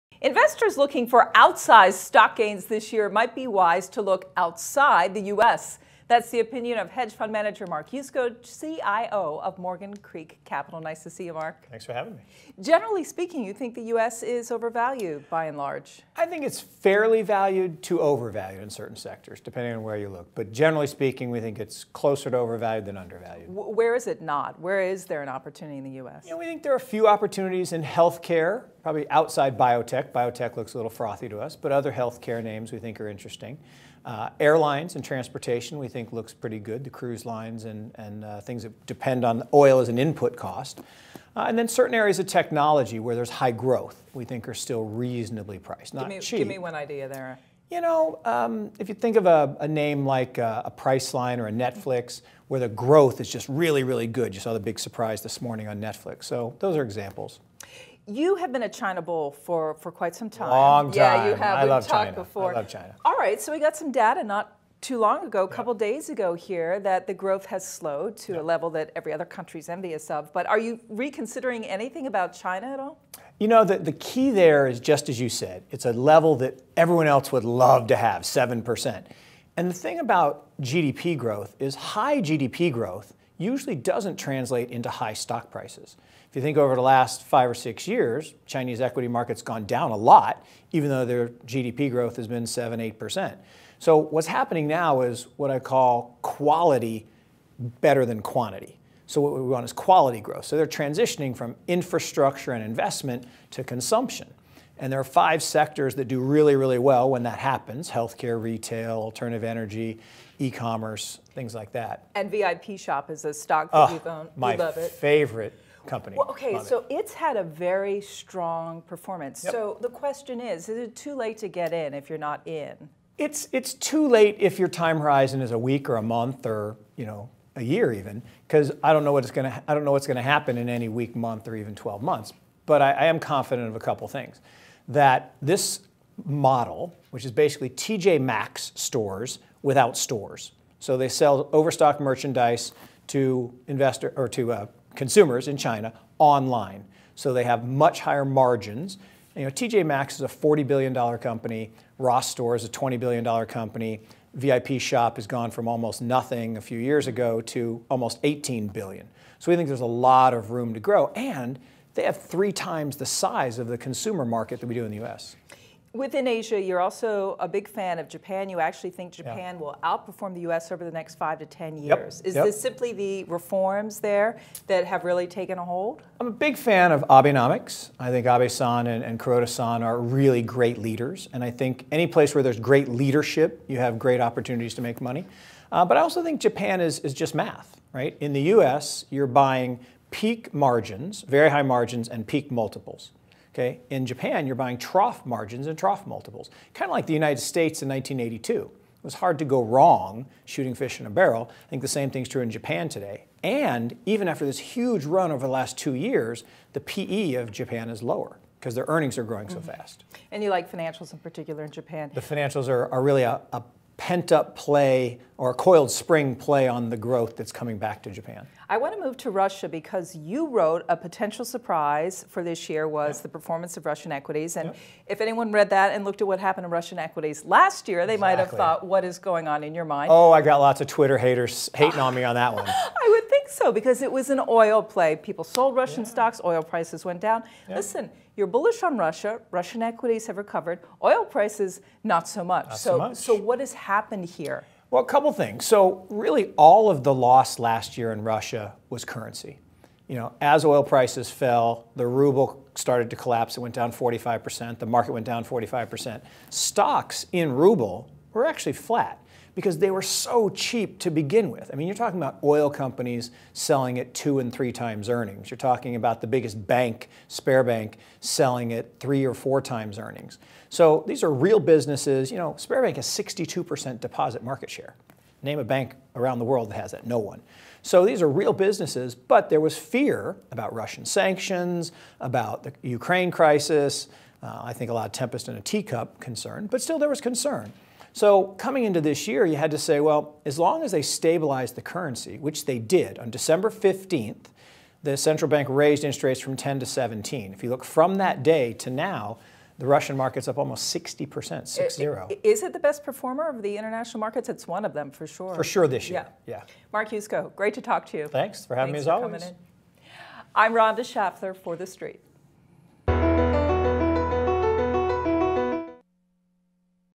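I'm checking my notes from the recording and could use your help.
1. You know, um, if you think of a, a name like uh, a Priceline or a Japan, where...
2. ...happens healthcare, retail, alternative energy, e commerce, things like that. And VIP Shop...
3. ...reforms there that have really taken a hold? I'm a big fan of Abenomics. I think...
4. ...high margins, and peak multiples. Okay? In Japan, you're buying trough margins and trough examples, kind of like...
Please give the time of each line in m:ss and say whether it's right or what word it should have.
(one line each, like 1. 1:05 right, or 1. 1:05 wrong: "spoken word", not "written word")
1. 0:47 wrong: "Netflix", not "Japan"
2. 1:47 right
3. 2:53 right
4. 3:11 wrong: "multiples", not "examples".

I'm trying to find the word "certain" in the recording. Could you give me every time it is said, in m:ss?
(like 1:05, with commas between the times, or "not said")
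0:18, 0:41.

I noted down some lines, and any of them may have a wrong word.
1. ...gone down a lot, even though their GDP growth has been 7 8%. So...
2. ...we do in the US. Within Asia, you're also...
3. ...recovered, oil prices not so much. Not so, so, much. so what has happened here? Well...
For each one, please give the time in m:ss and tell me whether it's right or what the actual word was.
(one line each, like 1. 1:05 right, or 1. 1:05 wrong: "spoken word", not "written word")
1. 1:29 right
2. 2:44 right
3. 4:00 right.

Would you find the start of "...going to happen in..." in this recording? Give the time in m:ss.
2:10.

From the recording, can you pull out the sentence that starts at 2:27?
So they have much higher margins.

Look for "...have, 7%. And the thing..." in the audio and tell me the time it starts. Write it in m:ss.
1:17.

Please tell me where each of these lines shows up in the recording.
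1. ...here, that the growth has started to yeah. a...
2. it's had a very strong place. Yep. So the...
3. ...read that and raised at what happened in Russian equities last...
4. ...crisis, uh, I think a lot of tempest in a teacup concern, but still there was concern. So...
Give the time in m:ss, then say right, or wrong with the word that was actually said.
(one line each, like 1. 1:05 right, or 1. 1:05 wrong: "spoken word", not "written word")
1. 1:06 wrong: "slowed", not "started"
2. 1:56 wrong: "performance", not "place"
3. 3:45 wrong: "looked", not "raised"
4. 4:43 right.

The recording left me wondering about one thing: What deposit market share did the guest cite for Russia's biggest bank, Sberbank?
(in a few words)
62%.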